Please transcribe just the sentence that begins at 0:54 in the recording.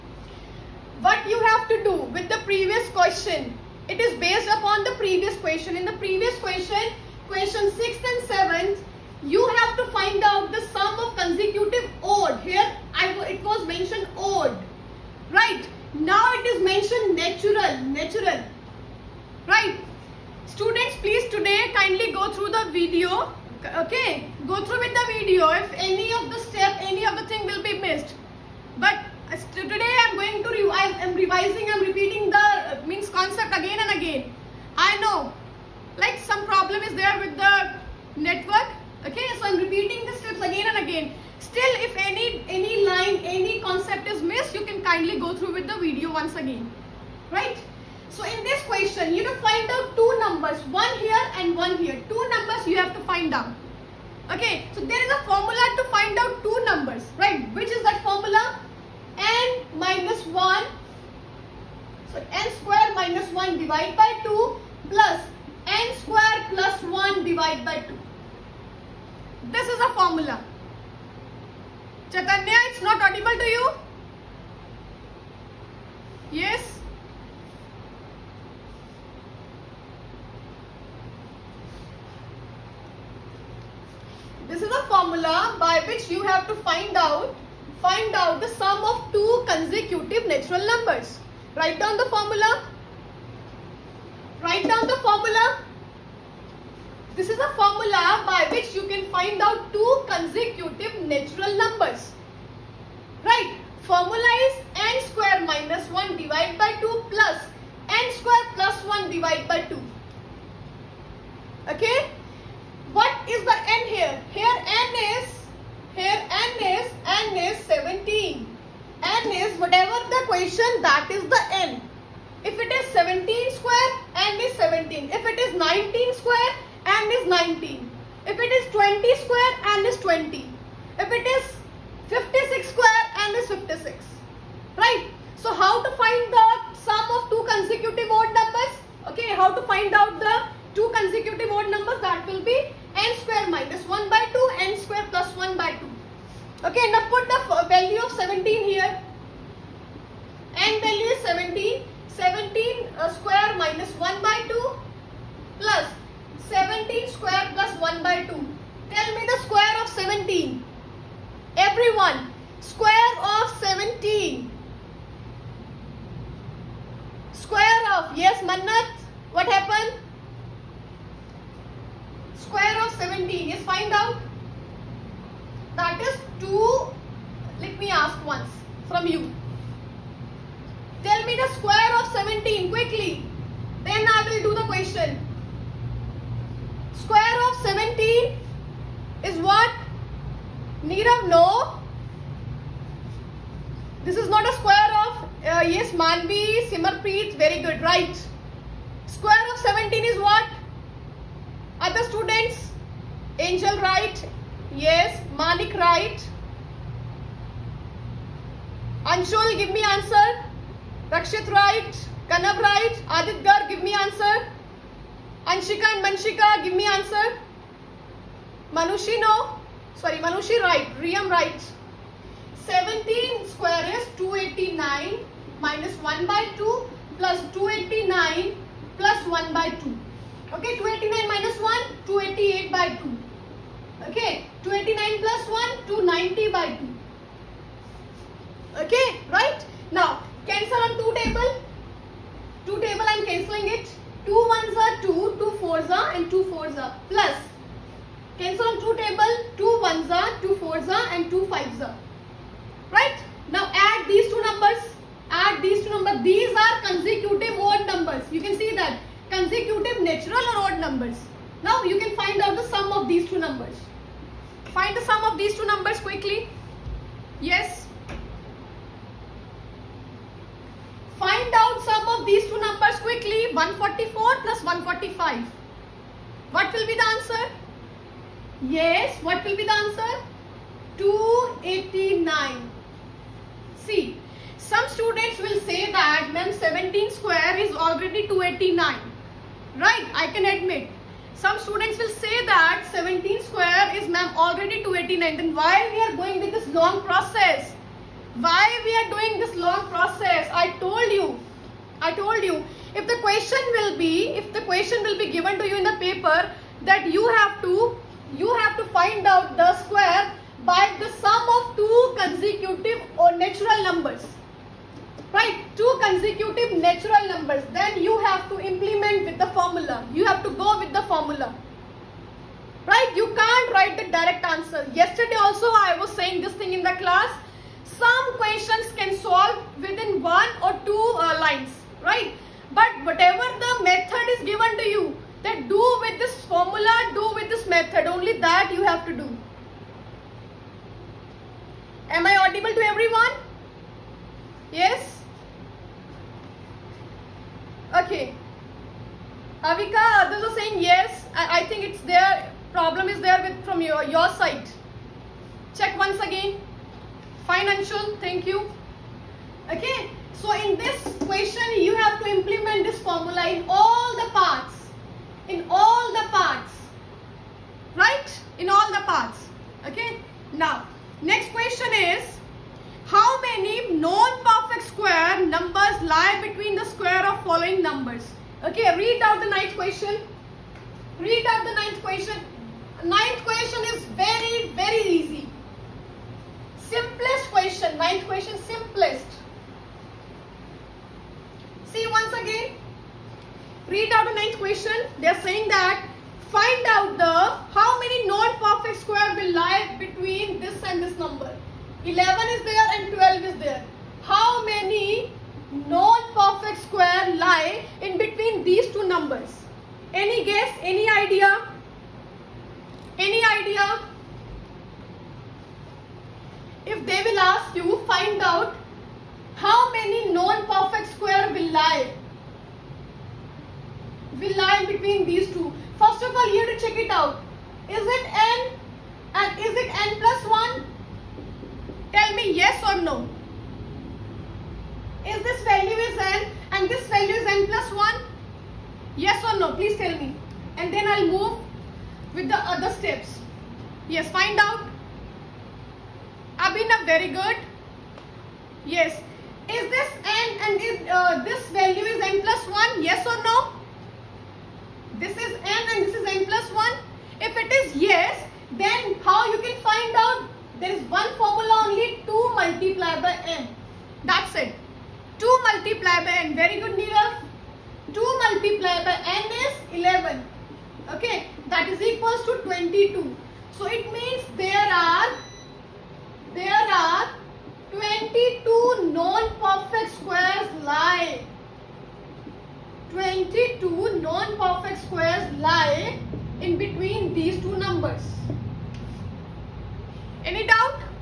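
Okay, so there is a formula to find out two numbers, right?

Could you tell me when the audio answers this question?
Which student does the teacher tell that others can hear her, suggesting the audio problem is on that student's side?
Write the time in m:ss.
5:49.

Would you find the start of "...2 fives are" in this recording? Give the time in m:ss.
4:11.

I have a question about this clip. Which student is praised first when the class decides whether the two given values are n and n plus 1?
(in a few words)
Abhinav.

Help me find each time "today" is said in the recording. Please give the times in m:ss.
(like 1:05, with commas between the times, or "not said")
0:21, 0:29.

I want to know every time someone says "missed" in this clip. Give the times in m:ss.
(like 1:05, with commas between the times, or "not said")
0:27, 0:44.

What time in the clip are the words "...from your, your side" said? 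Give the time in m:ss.
5:53.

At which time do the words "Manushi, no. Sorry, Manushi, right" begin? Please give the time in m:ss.
3:38.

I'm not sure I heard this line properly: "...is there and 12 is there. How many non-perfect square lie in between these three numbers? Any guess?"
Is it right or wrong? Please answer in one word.
wrong.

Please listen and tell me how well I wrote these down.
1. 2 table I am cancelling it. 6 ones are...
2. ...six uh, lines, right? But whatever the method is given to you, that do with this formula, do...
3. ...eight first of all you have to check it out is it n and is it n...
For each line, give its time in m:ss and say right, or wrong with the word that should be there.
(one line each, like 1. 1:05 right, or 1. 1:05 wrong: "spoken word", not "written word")
1. 4:02 wrong: "2", not "6"
2. 5:30 wrong: "two", not "six"
3. 7:05 wrong: "two", not "eight".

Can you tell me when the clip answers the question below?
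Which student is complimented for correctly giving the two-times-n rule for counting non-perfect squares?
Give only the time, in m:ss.
7:46.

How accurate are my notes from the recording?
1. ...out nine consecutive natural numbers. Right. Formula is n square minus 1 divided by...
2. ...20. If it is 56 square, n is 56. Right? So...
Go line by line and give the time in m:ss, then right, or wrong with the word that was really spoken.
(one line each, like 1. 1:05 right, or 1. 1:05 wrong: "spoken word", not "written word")
1. 1:39 wrong: "two", not "nine"
2. 2:10 right.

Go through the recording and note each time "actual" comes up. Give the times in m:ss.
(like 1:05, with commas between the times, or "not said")
not said.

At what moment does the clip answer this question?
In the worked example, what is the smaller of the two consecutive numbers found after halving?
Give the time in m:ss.
4:33.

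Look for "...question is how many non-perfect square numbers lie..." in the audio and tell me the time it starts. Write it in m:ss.
6:11.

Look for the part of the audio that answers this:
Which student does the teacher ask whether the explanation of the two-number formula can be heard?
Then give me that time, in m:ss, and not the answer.
1:12.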